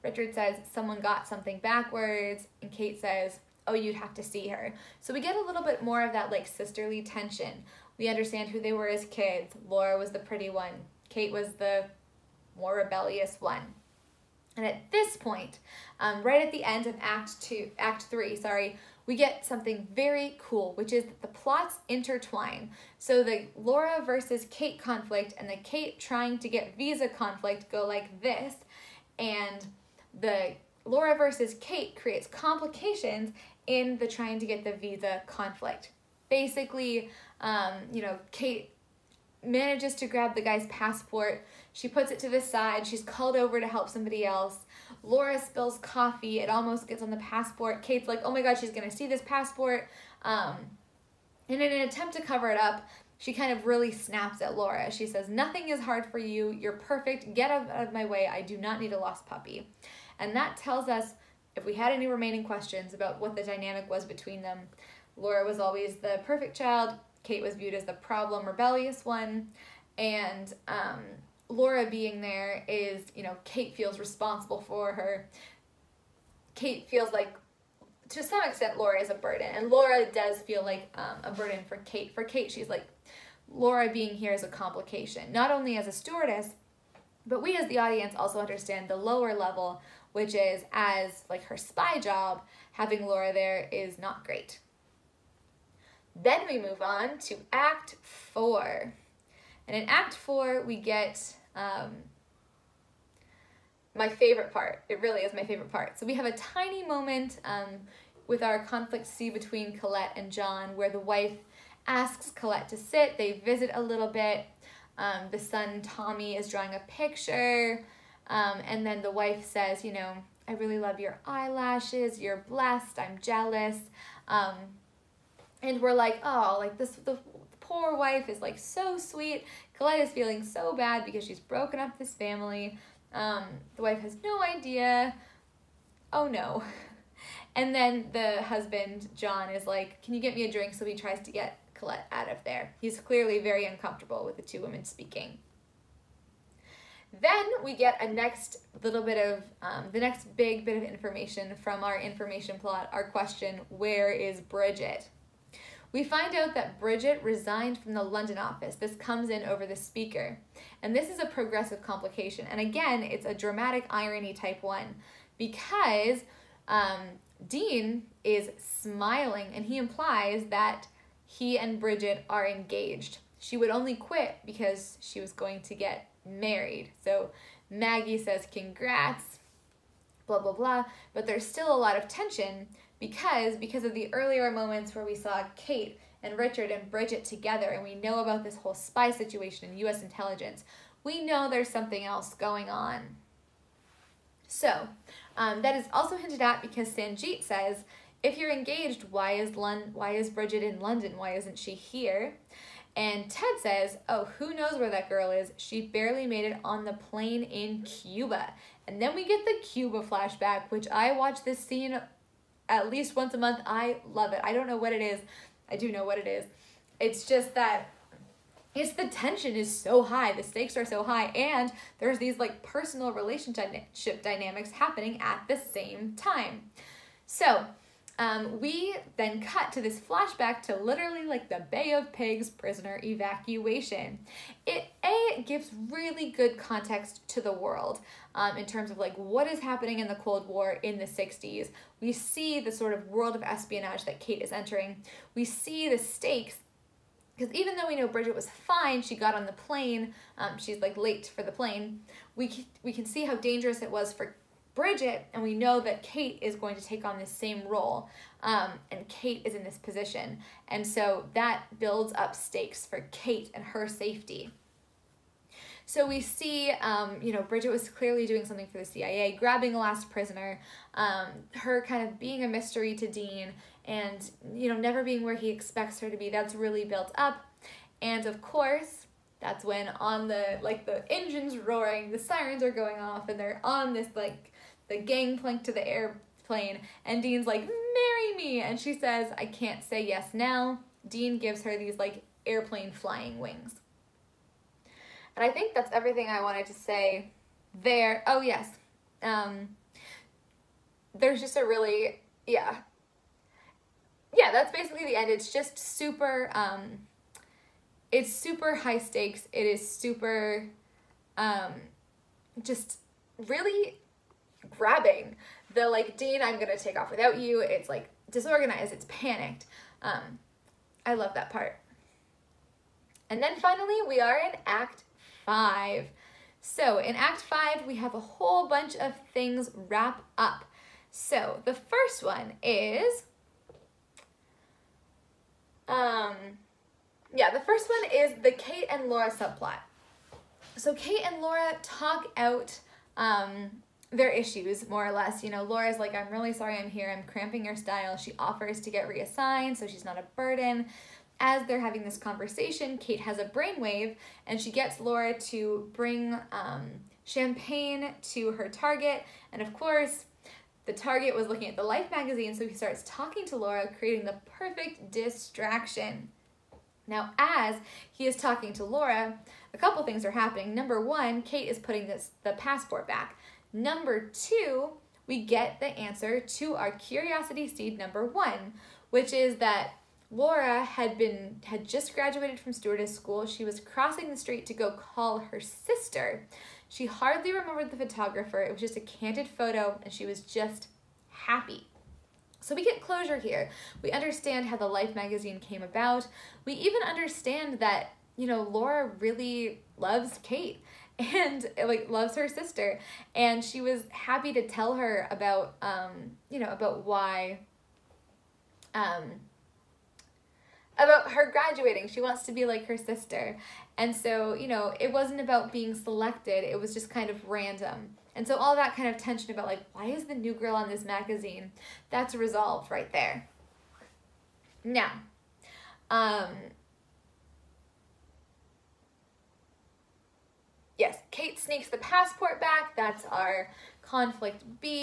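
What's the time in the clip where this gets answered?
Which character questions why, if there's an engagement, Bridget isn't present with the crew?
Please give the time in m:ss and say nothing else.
3:16.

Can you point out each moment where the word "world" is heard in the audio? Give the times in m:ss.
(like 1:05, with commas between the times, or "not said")
3:57, 4:03.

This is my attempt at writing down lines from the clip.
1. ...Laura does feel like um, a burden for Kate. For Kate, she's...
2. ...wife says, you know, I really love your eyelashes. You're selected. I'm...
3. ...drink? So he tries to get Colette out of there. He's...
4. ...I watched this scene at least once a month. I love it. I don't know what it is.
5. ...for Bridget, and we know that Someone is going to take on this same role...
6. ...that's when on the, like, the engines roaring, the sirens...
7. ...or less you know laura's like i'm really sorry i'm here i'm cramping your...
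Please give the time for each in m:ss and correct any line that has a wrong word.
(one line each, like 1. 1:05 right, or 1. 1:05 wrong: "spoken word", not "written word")
1. 1:19 right
2. 1:59 wrong: "blessed", not "selected"
3. 2:20 right
4. 3:30 right
5. 4:14 wrong: "Kate", not "Someone"
6. 4:39 right
7. 5:45 right.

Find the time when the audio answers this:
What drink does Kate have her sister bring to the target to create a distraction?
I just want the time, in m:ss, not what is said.
5:57.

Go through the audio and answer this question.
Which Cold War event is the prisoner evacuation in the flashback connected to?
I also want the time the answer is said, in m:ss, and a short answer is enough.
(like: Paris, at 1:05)
Bay of Pigs, at 3:51.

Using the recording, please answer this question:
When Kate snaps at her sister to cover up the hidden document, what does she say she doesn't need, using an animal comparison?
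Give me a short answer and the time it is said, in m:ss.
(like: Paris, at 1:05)
A lost puppy, at 0:58.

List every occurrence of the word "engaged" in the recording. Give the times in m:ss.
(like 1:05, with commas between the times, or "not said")
2:52, 3:18.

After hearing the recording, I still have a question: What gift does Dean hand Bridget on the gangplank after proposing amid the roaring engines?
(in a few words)
Airplane flying wings.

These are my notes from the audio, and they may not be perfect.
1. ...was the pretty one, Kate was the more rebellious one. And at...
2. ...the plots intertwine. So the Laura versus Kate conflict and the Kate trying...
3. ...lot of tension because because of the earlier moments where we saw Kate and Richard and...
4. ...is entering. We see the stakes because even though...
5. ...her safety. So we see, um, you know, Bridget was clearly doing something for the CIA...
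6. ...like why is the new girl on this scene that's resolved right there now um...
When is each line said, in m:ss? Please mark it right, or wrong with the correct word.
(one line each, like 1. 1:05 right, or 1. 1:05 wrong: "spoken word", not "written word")
1. 0:09 right
2. 0:21 right
3. 3:01 right
4. 4:04 right
5. 4:23 right
6. 6:59 wrong: "magazine", not "scene".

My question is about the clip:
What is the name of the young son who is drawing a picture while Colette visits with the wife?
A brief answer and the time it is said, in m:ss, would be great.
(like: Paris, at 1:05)
Tommy, at 1:55.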